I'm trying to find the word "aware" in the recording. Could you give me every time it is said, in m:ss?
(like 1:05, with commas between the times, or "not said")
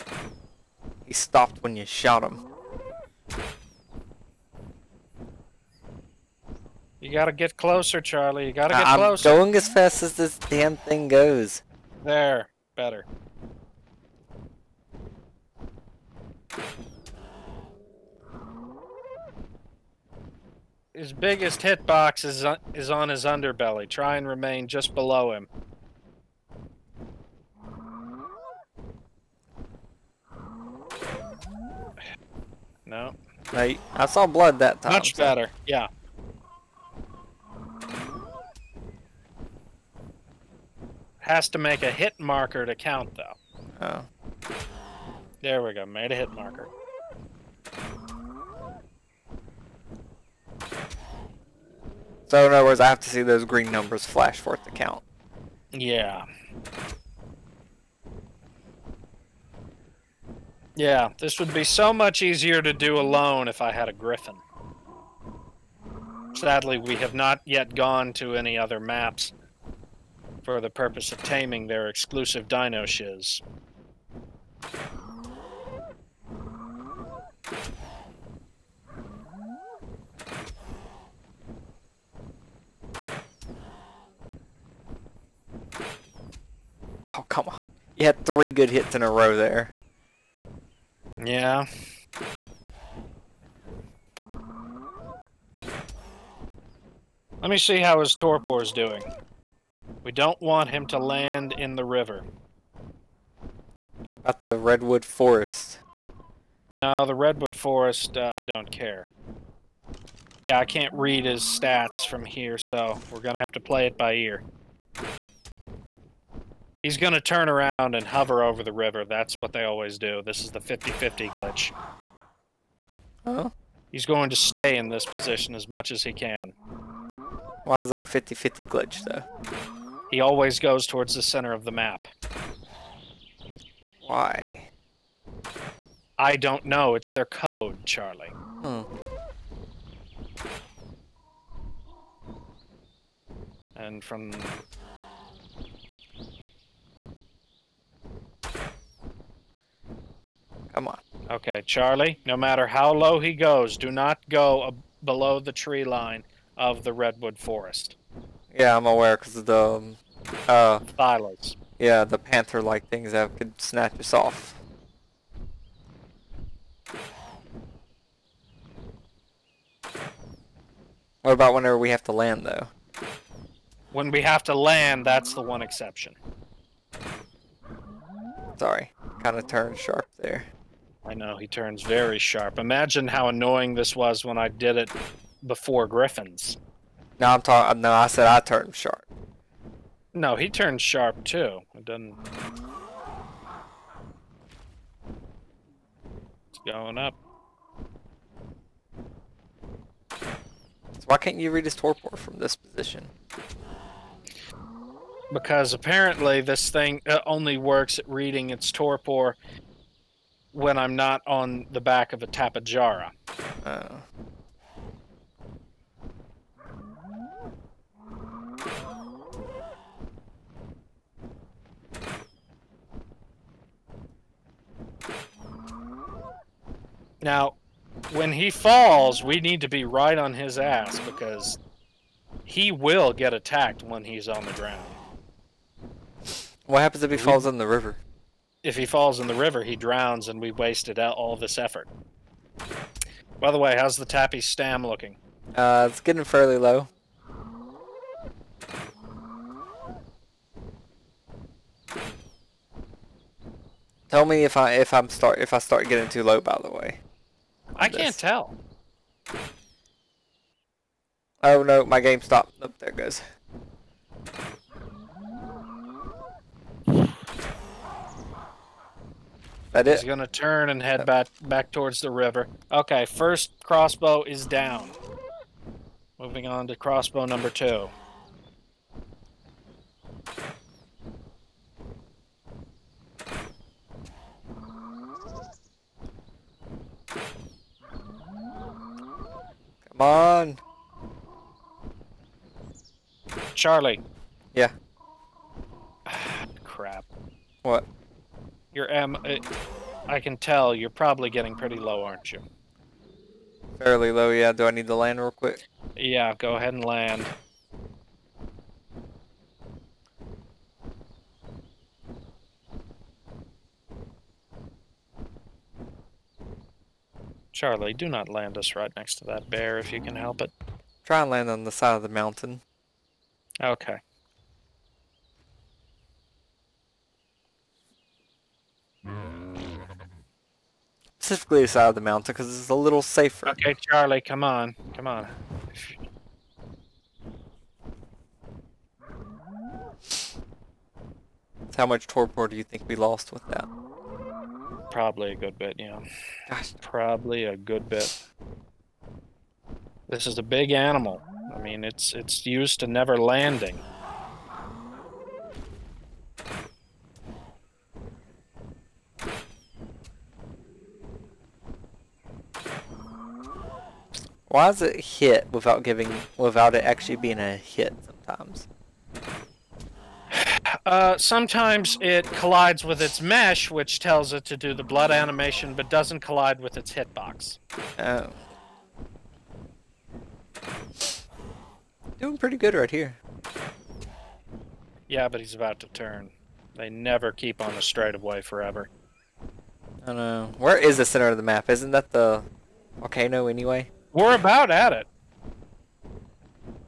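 2:38.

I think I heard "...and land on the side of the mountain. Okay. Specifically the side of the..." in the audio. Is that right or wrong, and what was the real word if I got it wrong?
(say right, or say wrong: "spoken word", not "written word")
right.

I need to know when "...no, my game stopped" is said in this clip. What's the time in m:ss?
4:21.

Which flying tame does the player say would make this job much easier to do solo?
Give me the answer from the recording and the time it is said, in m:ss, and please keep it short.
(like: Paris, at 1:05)
Griffin, at 1:03.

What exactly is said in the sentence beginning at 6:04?
Why does it hit without giving without it actually being a hit sometimes?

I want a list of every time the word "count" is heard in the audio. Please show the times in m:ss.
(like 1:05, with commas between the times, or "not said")
0:42, 0:54.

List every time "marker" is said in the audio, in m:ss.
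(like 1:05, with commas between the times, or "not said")
0:42, 0:46.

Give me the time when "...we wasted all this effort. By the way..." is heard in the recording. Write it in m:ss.
4:00.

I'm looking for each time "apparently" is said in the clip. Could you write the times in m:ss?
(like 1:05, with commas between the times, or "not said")
3:25.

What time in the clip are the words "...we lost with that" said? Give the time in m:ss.
5:42.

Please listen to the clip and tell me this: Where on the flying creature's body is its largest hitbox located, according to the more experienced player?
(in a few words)
Underbelly.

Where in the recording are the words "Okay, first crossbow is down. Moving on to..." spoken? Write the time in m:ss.
4:32.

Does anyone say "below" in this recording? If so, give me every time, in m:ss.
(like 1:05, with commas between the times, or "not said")
0:24, 2:35.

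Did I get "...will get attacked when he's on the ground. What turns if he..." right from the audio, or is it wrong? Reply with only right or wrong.
wrong.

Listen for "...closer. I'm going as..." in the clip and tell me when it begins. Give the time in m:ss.
0:08.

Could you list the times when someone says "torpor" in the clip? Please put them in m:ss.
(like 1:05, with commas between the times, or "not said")
1:38, 3:21, 3:28, 5:42.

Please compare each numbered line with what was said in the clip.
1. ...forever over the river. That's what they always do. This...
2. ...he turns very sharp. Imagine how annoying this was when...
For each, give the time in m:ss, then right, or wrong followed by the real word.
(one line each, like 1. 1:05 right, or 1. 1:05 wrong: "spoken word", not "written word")
1. 1:58 wrong: "hover", not "forever"
2. 3:01 right.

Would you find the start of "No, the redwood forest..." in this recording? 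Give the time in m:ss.
1:46.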